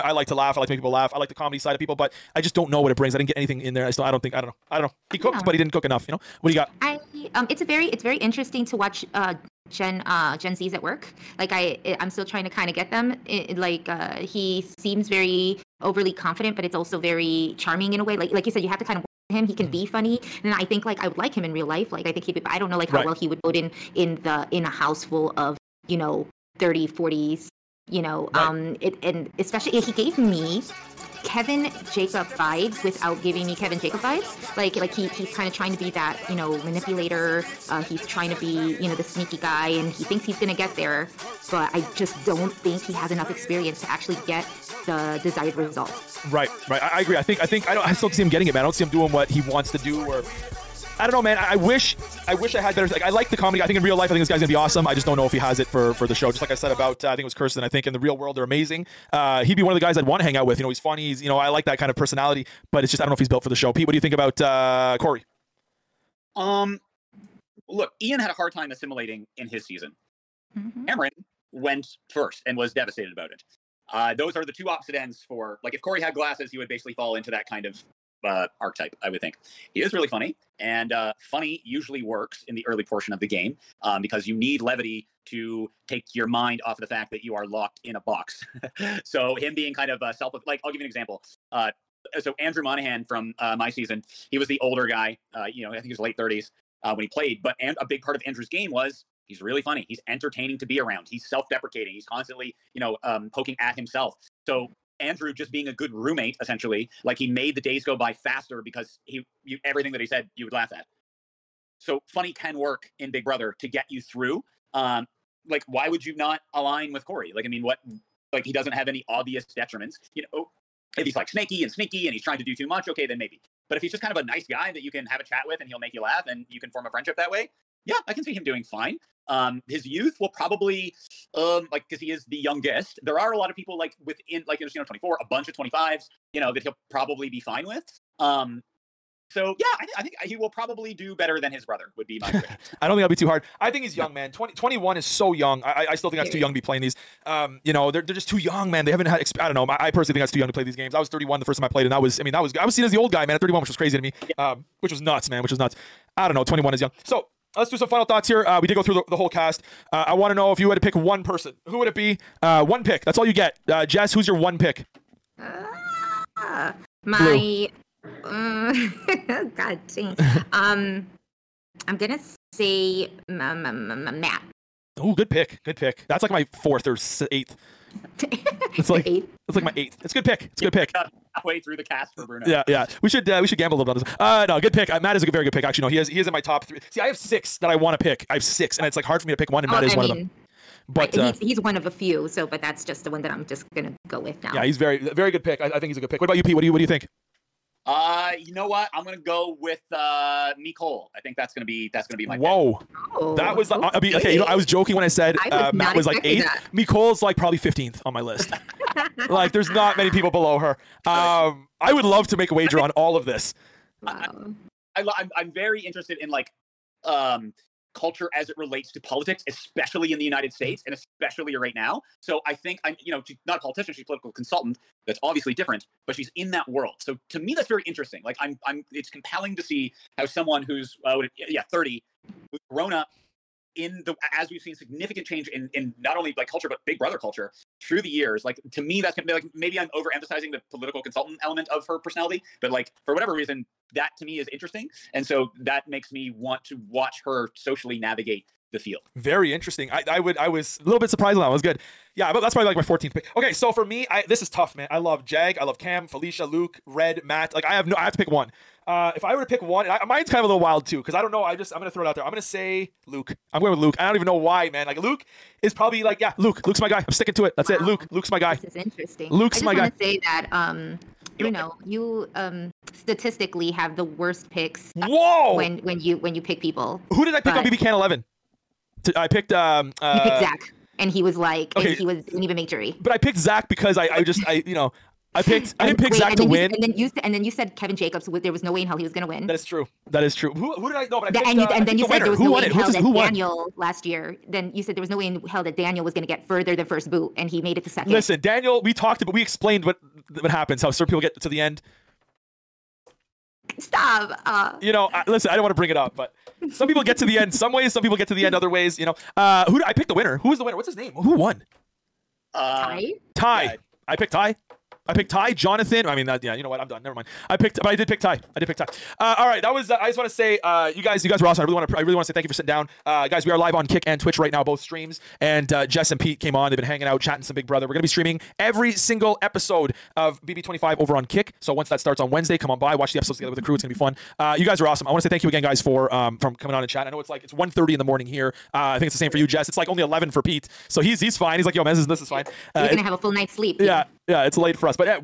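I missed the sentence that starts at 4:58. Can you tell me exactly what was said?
Listen, Daniel, we talked, but we explained what what happens.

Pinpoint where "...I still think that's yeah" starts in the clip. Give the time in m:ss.
2:25.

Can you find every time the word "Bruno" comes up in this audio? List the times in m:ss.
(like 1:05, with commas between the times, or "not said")
3:02, 4:31.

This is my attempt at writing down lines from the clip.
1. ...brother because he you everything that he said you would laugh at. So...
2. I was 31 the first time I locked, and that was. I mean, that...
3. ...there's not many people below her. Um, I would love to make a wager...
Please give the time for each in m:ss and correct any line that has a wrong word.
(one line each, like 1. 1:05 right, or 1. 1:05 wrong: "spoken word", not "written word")
1. 1:48 wrong: "faster", not "brother"
2. 2:30 wrong: "played", not "locked"
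3. 3:29 right.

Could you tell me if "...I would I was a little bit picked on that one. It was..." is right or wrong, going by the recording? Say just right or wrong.
wrong.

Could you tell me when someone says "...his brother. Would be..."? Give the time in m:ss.
2:21.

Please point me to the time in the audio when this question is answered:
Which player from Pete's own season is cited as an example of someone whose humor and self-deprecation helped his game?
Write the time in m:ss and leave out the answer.
1:32.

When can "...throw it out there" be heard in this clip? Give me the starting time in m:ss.
4:21.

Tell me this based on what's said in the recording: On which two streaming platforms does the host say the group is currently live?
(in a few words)
Kick and Twitch.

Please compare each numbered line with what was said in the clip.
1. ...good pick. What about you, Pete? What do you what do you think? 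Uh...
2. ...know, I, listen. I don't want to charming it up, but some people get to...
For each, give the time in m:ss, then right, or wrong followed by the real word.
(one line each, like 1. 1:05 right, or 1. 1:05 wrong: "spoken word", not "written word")
1. 3:16 right
2. 5:04 wrong: "bring", not "charming".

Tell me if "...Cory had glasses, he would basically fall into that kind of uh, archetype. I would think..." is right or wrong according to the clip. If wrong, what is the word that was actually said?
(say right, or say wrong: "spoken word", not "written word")
right.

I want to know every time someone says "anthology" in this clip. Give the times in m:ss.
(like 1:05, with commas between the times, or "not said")
not said.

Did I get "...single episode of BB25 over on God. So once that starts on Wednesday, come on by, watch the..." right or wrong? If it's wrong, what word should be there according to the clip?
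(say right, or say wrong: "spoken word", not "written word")
wrong: "Kick", not "God".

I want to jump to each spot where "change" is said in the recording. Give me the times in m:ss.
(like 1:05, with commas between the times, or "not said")
3:55.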